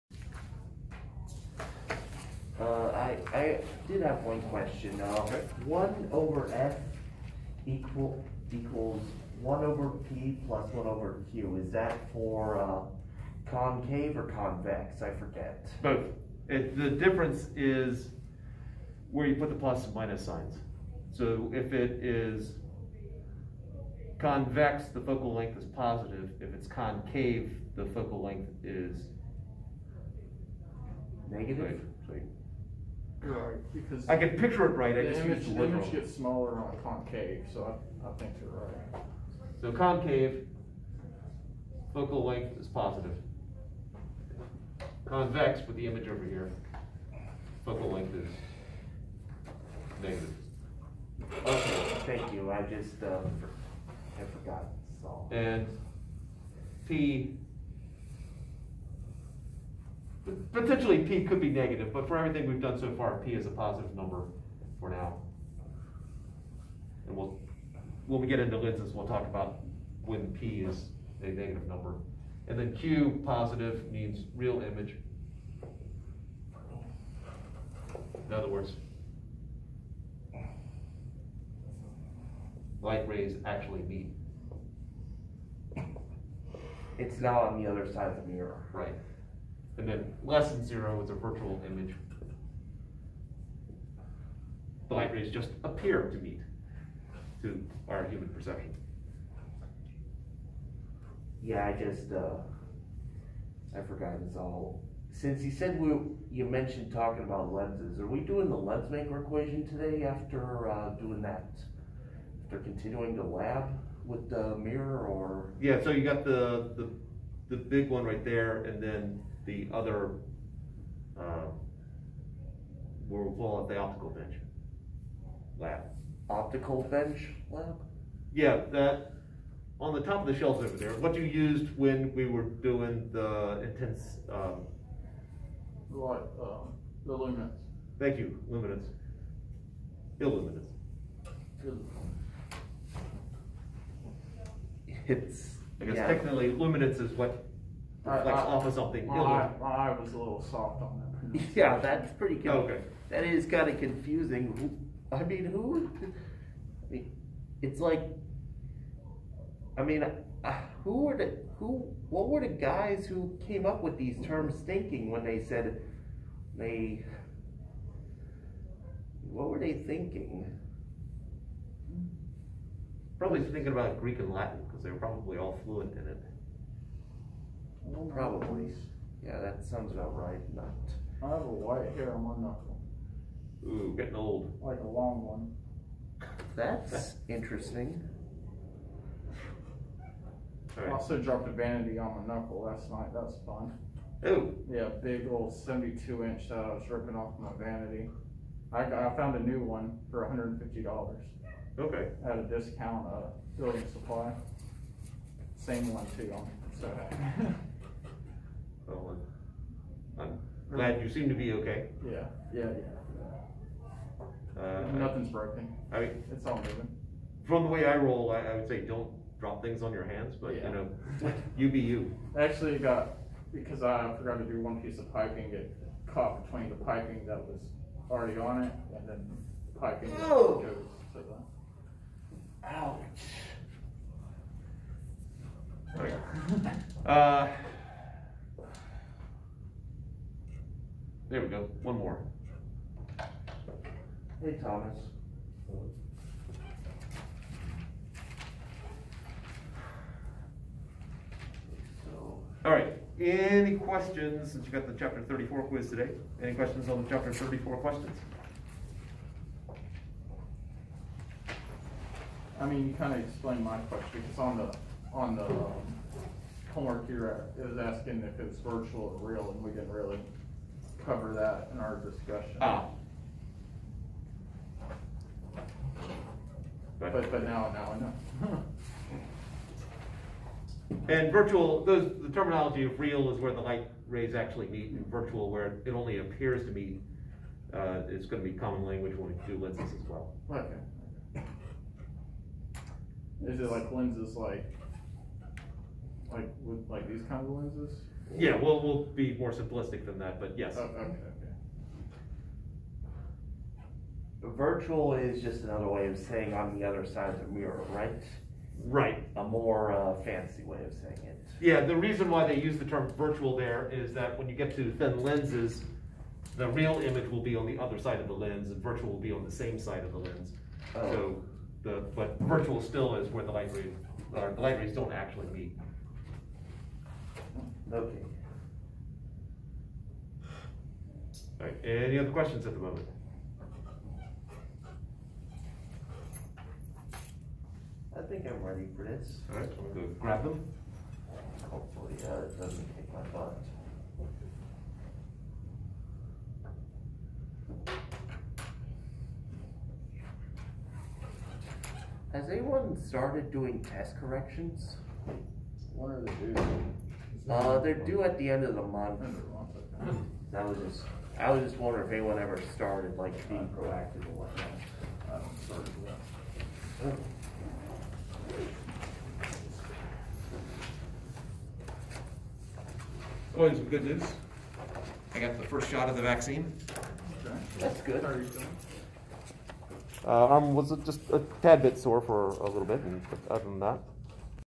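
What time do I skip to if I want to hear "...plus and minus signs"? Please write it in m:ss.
0:19.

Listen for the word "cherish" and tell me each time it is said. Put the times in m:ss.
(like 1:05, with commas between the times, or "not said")
not said.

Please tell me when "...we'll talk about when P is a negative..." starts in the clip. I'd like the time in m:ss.
1:08.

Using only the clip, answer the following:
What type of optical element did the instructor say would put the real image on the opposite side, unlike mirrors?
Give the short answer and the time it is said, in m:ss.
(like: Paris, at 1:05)
thin lenses, at 5:14.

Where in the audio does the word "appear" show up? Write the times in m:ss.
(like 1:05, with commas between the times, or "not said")
1:35, 4:46.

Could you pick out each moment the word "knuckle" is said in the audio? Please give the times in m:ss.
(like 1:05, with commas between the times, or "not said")
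3:02, 3:12.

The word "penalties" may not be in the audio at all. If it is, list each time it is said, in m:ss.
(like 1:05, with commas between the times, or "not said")
not said.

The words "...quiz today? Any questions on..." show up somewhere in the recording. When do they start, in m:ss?
4:15.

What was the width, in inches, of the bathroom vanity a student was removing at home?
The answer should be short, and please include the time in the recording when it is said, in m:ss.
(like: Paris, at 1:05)
72 inches, at 3:15.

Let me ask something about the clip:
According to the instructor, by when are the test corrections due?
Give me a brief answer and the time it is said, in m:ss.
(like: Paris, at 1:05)
end of the month, at 5:58.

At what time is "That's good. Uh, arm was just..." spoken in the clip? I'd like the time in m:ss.
6:17.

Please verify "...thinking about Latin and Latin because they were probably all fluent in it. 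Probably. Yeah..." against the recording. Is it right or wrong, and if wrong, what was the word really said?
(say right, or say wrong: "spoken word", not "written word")
wrong: "Greek", not "Latin".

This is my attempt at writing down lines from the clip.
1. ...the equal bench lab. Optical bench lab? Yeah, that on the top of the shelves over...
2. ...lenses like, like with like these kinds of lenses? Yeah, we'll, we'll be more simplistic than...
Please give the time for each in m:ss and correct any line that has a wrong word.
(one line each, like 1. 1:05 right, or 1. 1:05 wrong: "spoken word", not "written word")
1. 2:03 wrong: "optical", not "equal"
2. 4:53 right.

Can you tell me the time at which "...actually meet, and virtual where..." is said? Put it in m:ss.
4:44.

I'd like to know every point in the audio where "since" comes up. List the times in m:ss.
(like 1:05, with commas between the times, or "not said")
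1:45, 4:14.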